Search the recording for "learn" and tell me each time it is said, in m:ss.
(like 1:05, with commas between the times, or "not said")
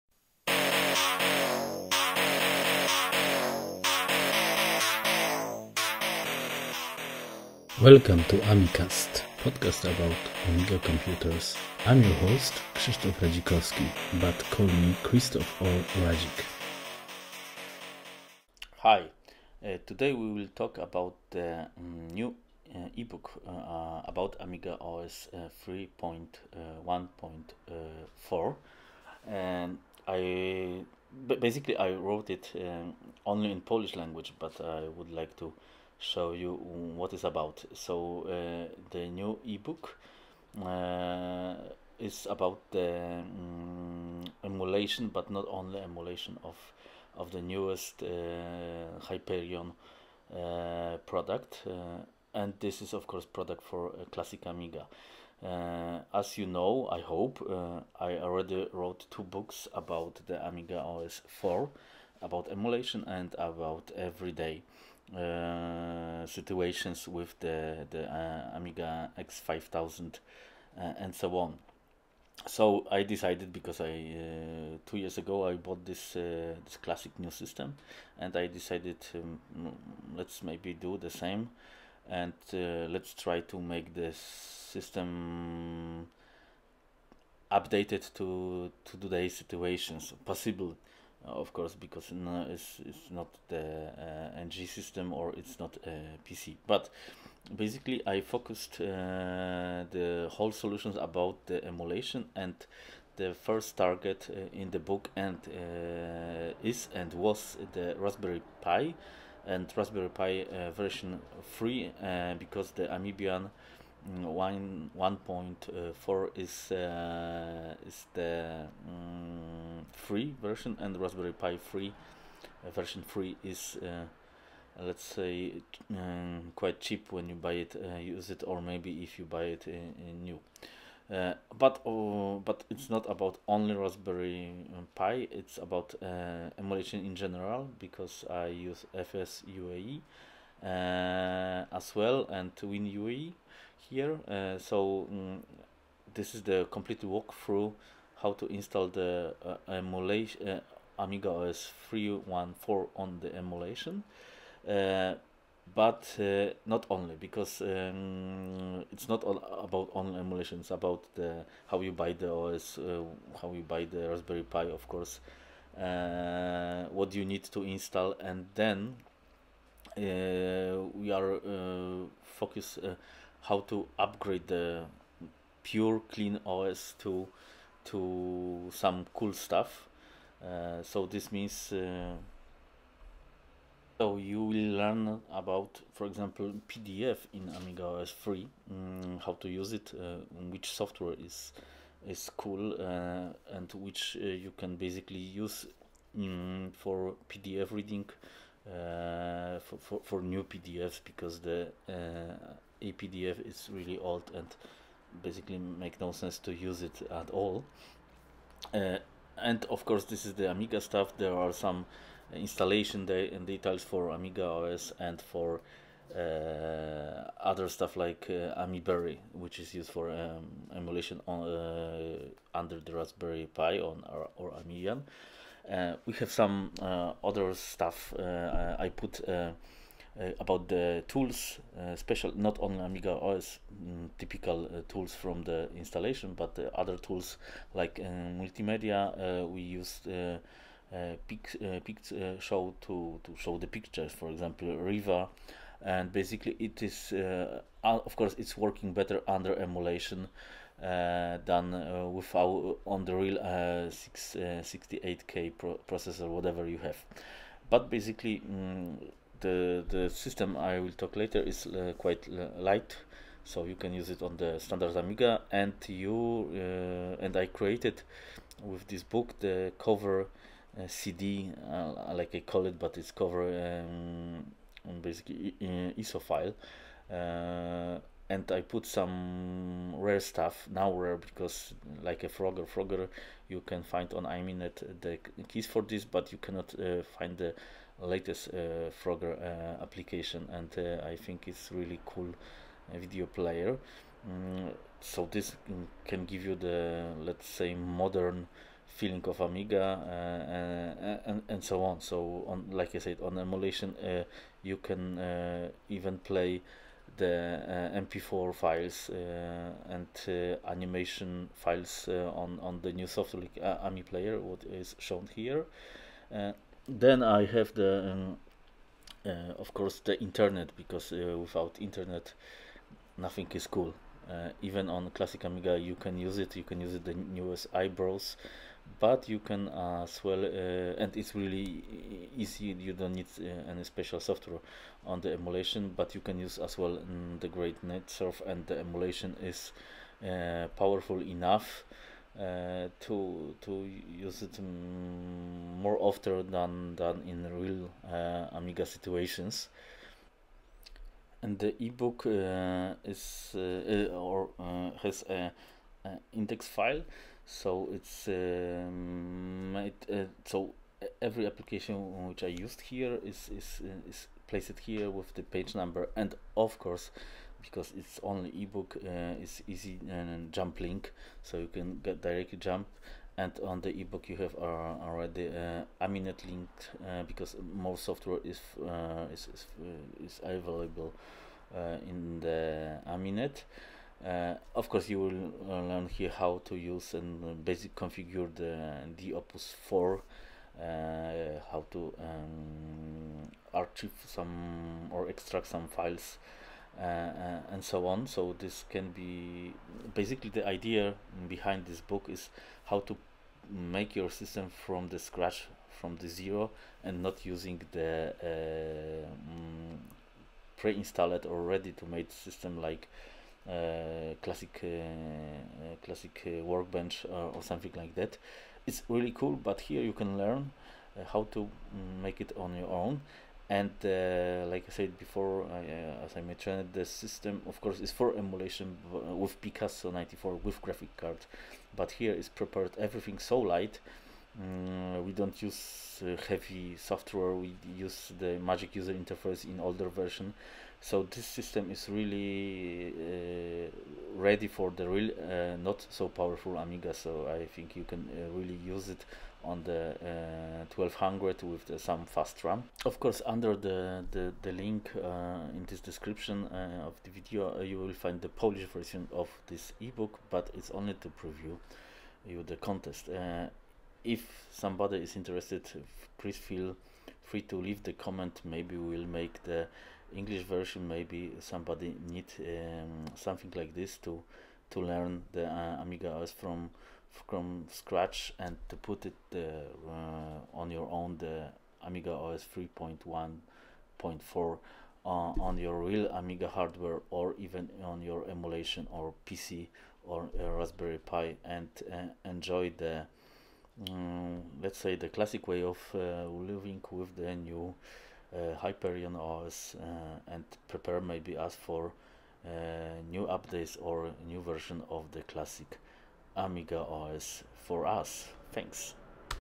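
3:04, 6:25, 7:00, 7:55.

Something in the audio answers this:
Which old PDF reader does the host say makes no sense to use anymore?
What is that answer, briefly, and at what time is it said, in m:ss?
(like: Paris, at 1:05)
APDF, at 3:22.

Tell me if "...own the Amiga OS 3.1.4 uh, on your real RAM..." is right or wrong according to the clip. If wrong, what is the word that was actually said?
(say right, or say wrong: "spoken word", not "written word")
wrong: "Amiga", not "RAM".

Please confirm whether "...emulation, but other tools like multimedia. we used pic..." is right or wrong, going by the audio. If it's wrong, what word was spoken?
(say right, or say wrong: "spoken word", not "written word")
wrong: "installation", not "emulation".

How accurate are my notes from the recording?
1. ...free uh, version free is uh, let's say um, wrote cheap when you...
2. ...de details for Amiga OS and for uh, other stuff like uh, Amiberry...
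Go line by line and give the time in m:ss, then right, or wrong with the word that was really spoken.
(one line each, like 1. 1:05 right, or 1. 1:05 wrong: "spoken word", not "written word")
1. 2:01 wrong: "quite", not "wrote"
2. 3:33 right.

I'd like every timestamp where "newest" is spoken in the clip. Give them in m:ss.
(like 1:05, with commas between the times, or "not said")
0:47, 5:27.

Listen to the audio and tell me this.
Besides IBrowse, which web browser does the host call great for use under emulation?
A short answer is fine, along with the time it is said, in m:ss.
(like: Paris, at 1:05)
NetSurf, at 5:37.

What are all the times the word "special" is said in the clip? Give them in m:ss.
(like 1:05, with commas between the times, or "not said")
3:51, 5:33.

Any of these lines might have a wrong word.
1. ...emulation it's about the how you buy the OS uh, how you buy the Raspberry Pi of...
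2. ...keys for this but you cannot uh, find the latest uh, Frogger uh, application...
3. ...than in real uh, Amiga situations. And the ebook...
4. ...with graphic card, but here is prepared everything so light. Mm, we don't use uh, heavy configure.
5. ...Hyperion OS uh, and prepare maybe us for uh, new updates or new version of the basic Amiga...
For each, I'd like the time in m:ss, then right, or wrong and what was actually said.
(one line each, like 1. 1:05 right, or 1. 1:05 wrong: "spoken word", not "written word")
1. 2:40 right
2. 4:45 right
3. 5:46 right
4. 7:10 wrong: "software", not "configure"
5. 8:18 wrong: "classic", not "basic".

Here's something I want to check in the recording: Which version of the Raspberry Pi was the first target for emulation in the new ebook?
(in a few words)
3.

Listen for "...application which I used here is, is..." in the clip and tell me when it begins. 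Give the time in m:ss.
6:01.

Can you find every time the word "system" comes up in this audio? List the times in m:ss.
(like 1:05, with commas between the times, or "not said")
1:17, 1:24, 1:34, 4:20, 6:44, 6:52, 7:07, 7:21.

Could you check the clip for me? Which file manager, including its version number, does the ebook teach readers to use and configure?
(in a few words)
Opus 4.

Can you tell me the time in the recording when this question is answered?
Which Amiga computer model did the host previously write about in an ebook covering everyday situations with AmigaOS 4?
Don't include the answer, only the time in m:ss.
1:08.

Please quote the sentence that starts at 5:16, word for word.
then I have the, um, of course, the internet, because without internet, nothing is cool.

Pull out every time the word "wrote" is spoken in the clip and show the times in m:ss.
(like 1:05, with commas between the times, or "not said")
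0:31, 0:58.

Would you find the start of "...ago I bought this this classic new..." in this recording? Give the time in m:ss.
1:15.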